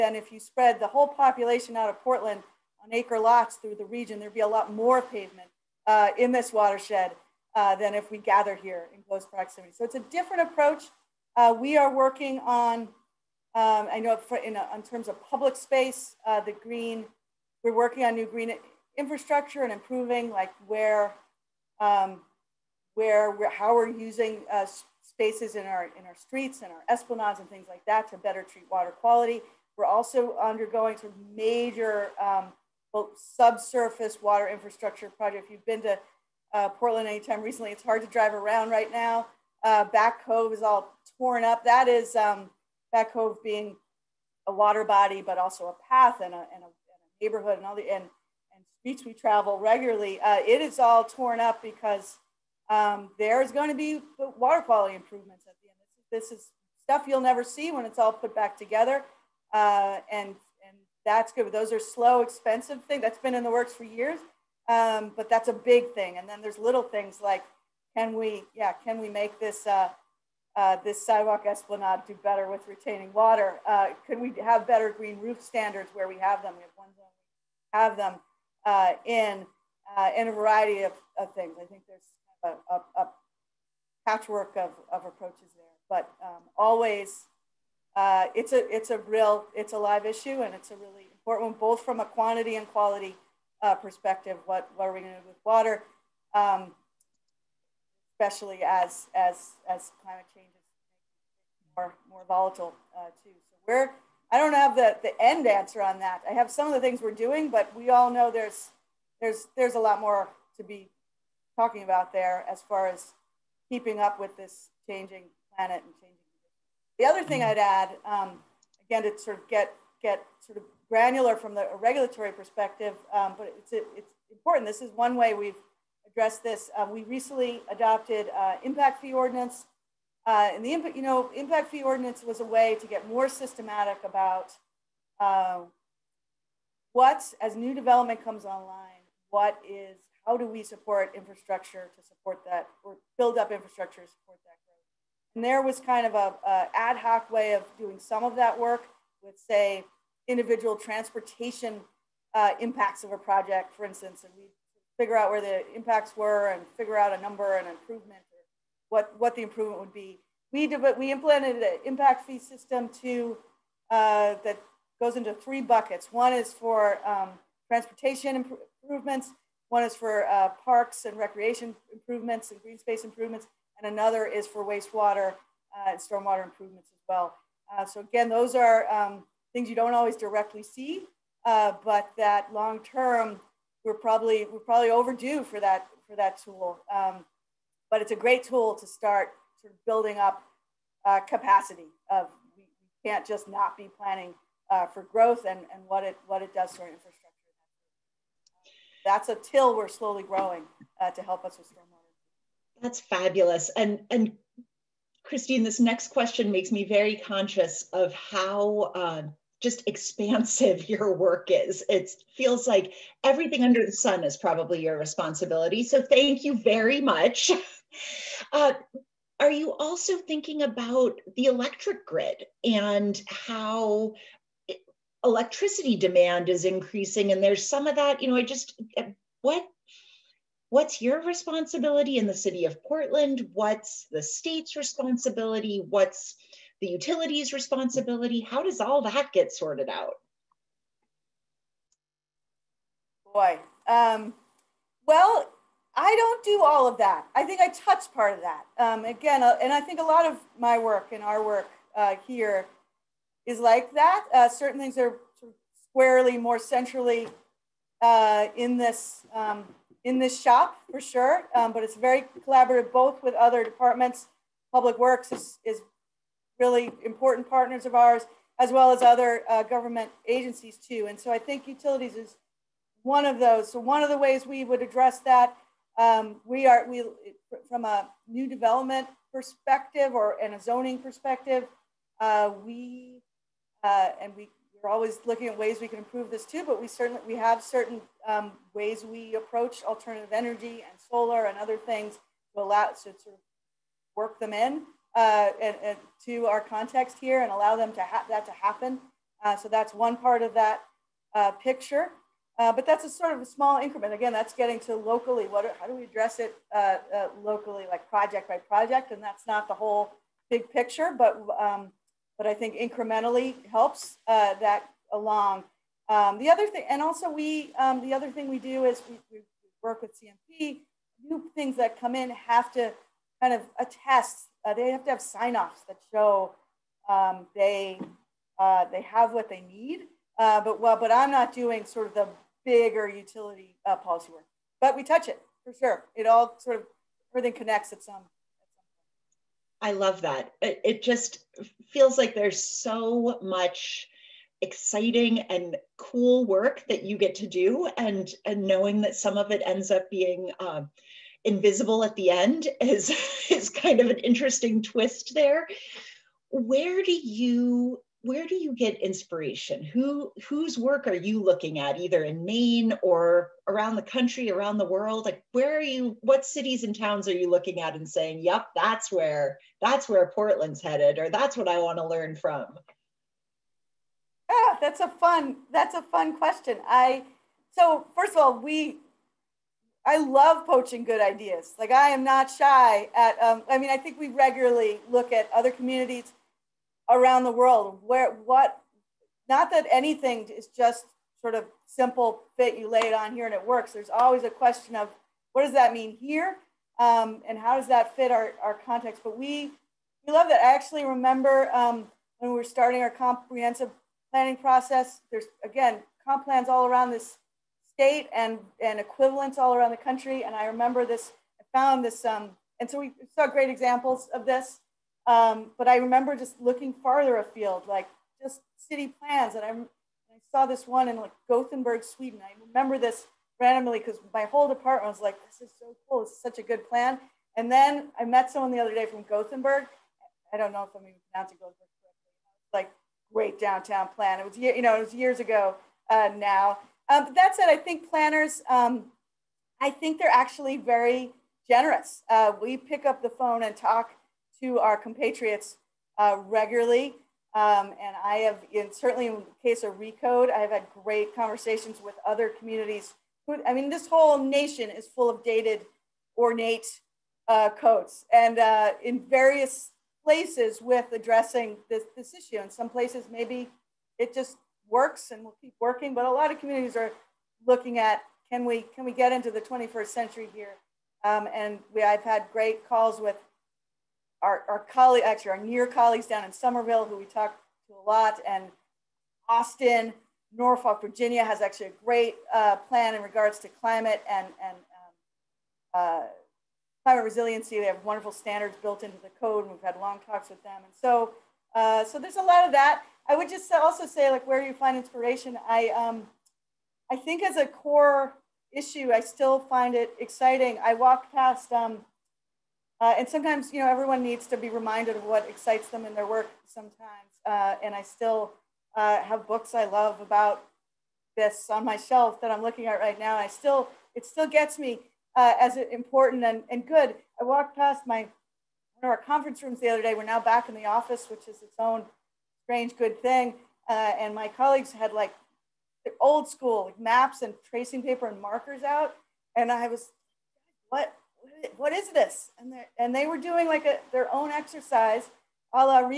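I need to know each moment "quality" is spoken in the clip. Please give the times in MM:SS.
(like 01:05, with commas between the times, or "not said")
00:28, 00:54, 01:32.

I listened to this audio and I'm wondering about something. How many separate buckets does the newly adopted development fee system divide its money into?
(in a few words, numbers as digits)
3.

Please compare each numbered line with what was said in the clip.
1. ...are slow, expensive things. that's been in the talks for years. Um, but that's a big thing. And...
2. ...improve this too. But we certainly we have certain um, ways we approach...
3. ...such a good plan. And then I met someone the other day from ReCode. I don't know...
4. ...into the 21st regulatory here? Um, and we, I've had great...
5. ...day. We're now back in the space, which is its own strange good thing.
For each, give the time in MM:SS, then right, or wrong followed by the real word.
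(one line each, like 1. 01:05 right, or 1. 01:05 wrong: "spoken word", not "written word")
1. 01:01 wrong: "works", not "talks"
2. 04:45 right
3. 07:06 wrong: "Gothenburg", not "ReCode"
4. 07:49 wrong: "century", not "regulatory"
5. 08:40 wrong: "office", not "space".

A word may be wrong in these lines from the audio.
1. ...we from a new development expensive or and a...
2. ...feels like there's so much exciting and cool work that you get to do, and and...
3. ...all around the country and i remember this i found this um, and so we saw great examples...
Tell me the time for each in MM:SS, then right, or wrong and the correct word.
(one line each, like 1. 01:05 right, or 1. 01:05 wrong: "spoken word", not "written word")
1. 04:36 wrong: "perspective", not "expensive"
2. 05:41 right
3. 06:49 right.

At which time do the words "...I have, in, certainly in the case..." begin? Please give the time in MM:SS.
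07:28.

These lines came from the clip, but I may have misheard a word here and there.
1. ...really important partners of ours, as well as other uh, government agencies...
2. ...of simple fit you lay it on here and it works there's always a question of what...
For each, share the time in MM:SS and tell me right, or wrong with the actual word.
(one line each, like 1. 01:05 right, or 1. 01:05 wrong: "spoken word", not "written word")
1. 04:26 right
2. 06:31 right.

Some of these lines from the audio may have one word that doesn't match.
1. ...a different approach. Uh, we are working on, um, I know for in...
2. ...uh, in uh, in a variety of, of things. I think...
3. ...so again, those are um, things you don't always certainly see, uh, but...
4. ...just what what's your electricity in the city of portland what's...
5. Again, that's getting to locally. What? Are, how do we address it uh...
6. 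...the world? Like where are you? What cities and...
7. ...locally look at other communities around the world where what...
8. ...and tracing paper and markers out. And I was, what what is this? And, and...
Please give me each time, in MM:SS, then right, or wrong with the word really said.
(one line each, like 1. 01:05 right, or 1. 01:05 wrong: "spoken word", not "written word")
1. 00:09 right
2. 01:18 right
3. 02:57 wrong: "directly", not "certainly"
4. 03:48 wrong: "responsibility", not "electricity"
5. 05:04 right
6. 06:04 right
7. 06:24 wrong: "regularly", not "locally"
8. 08:47 right.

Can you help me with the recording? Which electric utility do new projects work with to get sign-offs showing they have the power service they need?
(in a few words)
CMP.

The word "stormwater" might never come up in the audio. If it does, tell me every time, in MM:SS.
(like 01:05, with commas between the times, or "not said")
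02:55, 03:21.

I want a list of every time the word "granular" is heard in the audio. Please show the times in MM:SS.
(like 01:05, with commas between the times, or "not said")
02:00.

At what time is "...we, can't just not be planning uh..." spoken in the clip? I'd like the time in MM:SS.
03:12.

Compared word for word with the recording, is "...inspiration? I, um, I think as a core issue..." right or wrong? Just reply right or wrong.
right.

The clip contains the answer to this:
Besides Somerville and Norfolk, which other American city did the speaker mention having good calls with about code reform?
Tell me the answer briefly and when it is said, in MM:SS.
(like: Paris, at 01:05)
Austin, at 07:59.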